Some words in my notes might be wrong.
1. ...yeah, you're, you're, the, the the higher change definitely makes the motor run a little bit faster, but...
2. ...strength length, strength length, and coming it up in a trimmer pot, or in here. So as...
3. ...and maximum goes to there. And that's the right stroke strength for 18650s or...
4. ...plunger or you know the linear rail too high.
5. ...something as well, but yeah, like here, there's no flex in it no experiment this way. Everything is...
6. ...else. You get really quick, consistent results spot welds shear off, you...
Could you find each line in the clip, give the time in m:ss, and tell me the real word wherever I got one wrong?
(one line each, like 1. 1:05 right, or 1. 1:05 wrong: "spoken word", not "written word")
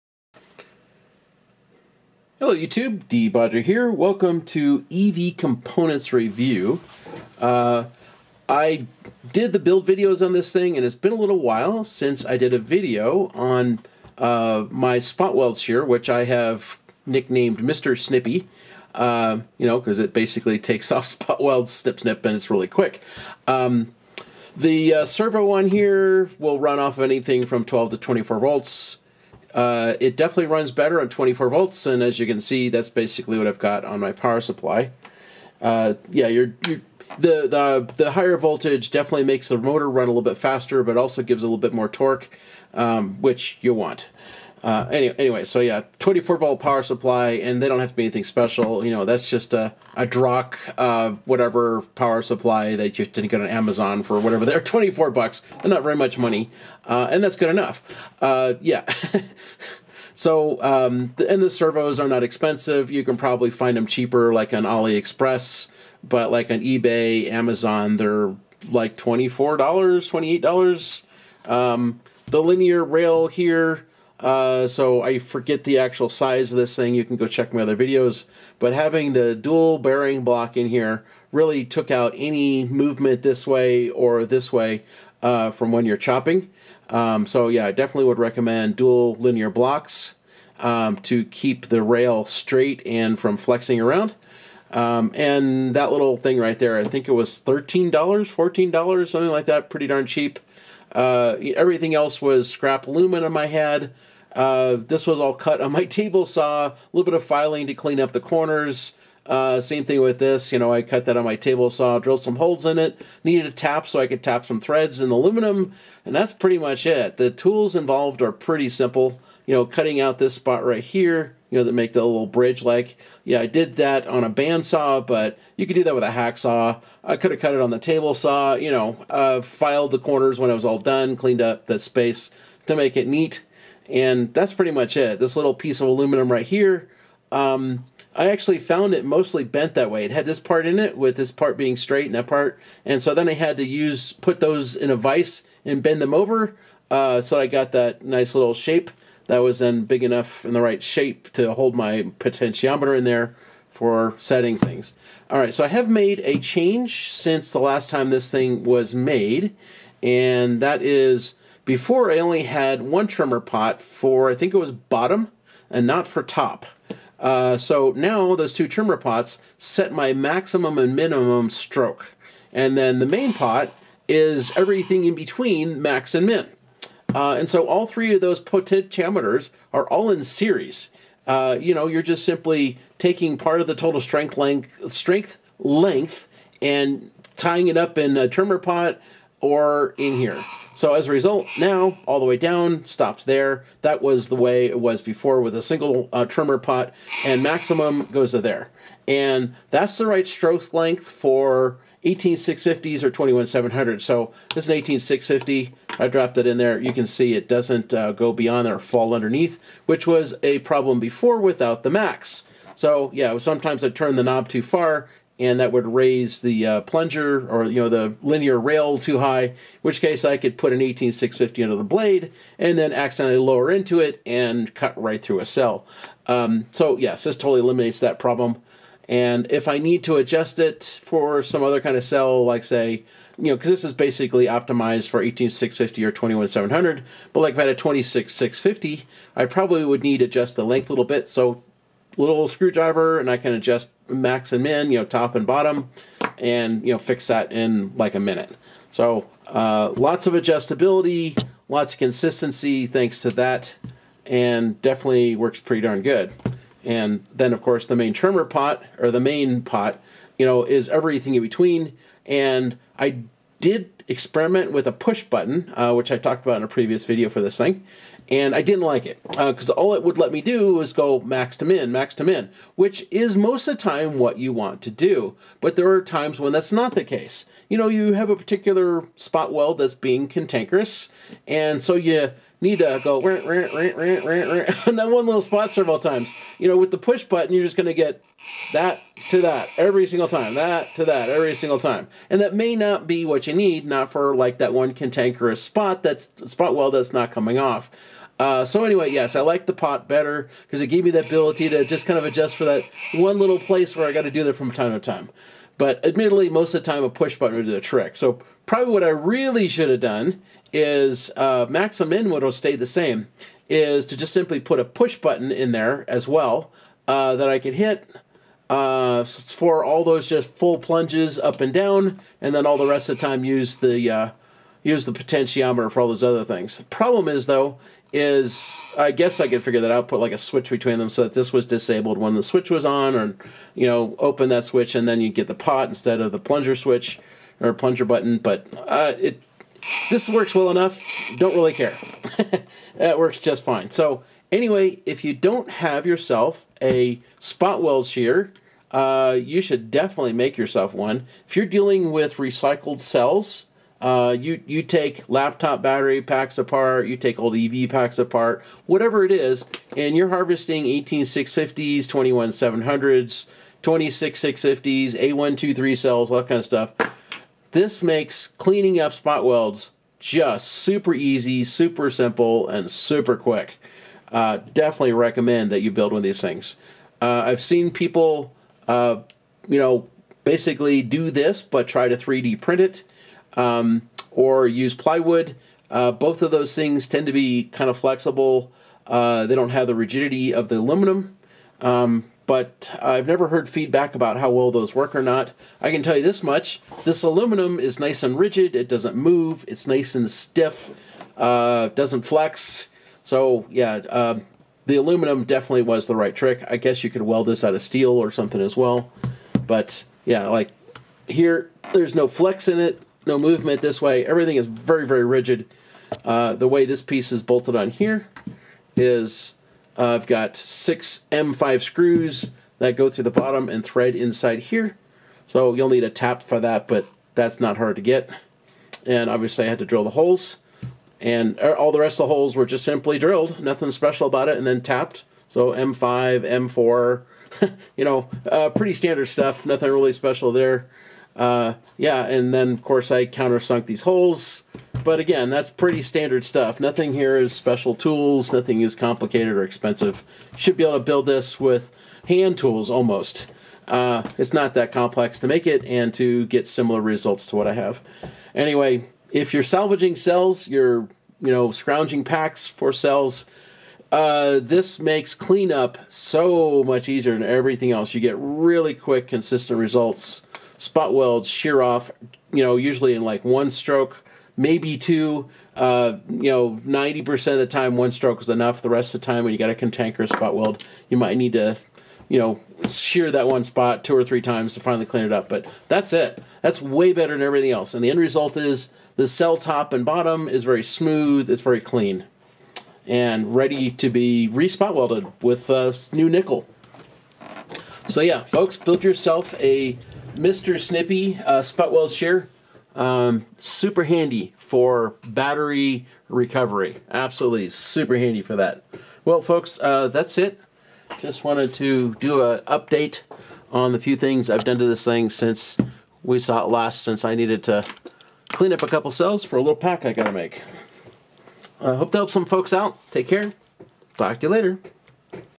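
1. 0:36 wrong: "voltage", not "change"
2. 3:04 wrong: "tying", not "coming"
3. 3:17 wrong: "length", not "strength"
4. 3:36 right
5. 6:48 wrong: "movement", not "experiment"
6. 7:47 right.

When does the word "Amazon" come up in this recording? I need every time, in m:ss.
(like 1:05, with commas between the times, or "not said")
0:53, 1:07.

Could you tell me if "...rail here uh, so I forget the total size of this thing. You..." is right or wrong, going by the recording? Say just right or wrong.
wrong.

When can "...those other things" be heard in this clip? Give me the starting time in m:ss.
5:26.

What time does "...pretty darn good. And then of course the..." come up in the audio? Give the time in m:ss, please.
4:15.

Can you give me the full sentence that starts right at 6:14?
Uh, definitely recommend that you build one of these things.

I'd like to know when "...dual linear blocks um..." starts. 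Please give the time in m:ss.
1:28.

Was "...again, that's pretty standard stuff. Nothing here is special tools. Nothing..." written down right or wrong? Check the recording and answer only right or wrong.
right.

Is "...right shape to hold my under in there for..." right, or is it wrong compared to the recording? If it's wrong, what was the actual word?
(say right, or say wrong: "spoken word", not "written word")
wrong: "potentiometer", not "under".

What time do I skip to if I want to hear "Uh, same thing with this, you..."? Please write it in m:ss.
1:49.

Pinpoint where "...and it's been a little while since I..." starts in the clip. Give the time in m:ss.
0:10.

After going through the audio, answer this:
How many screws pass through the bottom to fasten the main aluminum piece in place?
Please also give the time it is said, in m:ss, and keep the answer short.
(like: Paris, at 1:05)
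6, at 7:00.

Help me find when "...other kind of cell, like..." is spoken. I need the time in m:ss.
3:51.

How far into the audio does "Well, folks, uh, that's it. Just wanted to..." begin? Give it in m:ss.
8:29.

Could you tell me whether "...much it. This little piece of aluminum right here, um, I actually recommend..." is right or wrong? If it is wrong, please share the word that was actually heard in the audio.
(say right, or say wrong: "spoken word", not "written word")
wrong: "found", not "recommend".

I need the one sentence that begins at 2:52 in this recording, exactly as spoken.
And then the main pot is everything in between max and min.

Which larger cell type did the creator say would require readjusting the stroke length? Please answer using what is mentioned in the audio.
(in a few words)
26650.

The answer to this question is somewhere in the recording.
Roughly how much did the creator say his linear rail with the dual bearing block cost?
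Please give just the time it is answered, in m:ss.
1:37.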